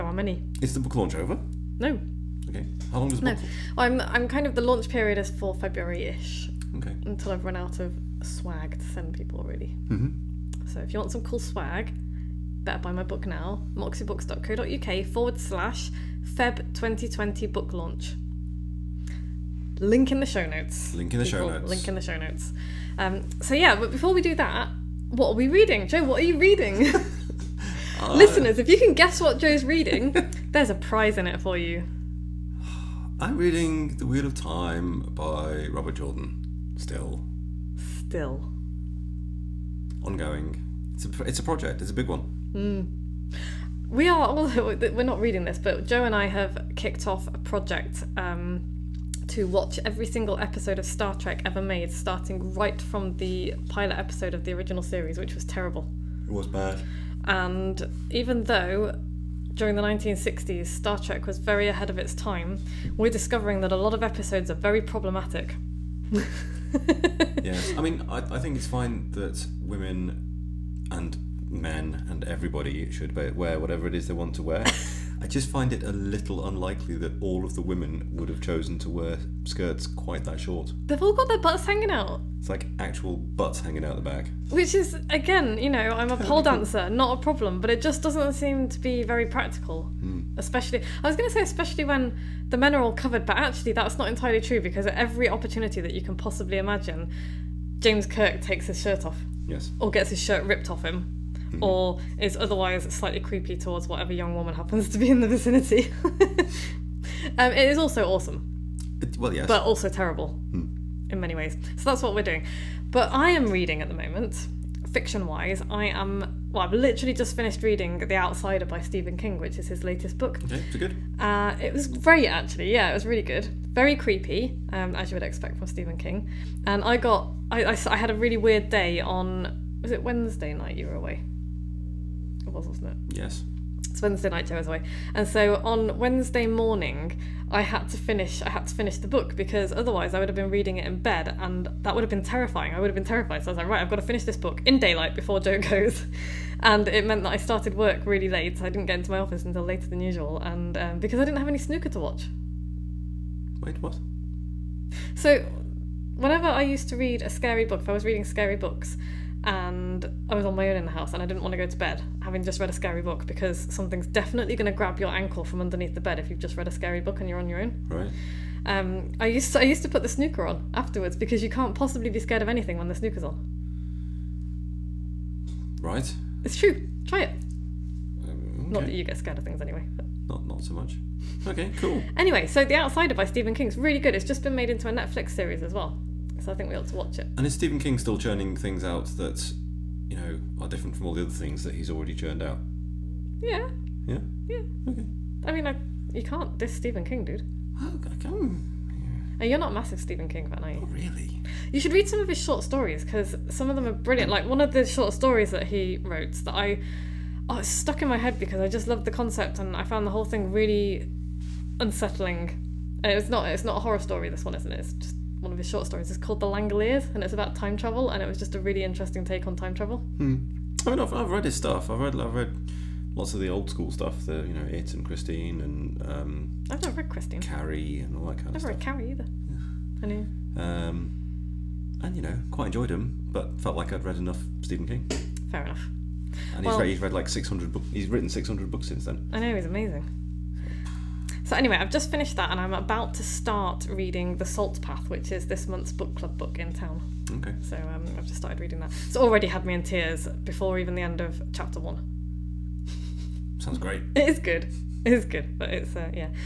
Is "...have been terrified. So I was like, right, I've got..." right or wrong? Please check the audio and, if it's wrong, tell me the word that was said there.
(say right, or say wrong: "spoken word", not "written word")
right.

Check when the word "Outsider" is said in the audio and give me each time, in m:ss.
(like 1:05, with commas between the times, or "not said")
1:58, 3:02.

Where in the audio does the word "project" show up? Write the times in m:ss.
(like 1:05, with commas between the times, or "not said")
0:41, 0:47.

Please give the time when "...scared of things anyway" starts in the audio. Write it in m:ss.
2:59.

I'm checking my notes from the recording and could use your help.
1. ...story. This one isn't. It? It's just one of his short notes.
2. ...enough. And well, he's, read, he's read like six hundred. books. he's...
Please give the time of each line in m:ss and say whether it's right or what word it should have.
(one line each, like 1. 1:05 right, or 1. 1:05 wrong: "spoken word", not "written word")
1. 3:33 wrong: "stories", not "notes"
2. 3:55 right.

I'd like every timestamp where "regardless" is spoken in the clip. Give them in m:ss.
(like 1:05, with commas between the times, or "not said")
not said.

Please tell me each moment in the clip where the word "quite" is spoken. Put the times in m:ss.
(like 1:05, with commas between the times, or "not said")
1:19, 3:52.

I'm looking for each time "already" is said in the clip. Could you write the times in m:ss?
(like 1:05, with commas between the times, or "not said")
3:11, 4:09.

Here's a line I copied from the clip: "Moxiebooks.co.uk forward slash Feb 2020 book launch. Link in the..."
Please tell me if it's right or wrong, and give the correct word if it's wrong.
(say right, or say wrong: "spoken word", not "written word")
right.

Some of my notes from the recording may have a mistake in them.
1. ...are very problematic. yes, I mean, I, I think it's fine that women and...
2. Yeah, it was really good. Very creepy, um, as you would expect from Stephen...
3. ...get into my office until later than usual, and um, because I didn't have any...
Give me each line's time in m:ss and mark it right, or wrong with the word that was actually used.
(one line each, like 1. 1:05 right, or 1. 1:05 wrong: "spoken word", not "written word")
1. 1:04 right
2. 2:02 right
3. 2:28 right.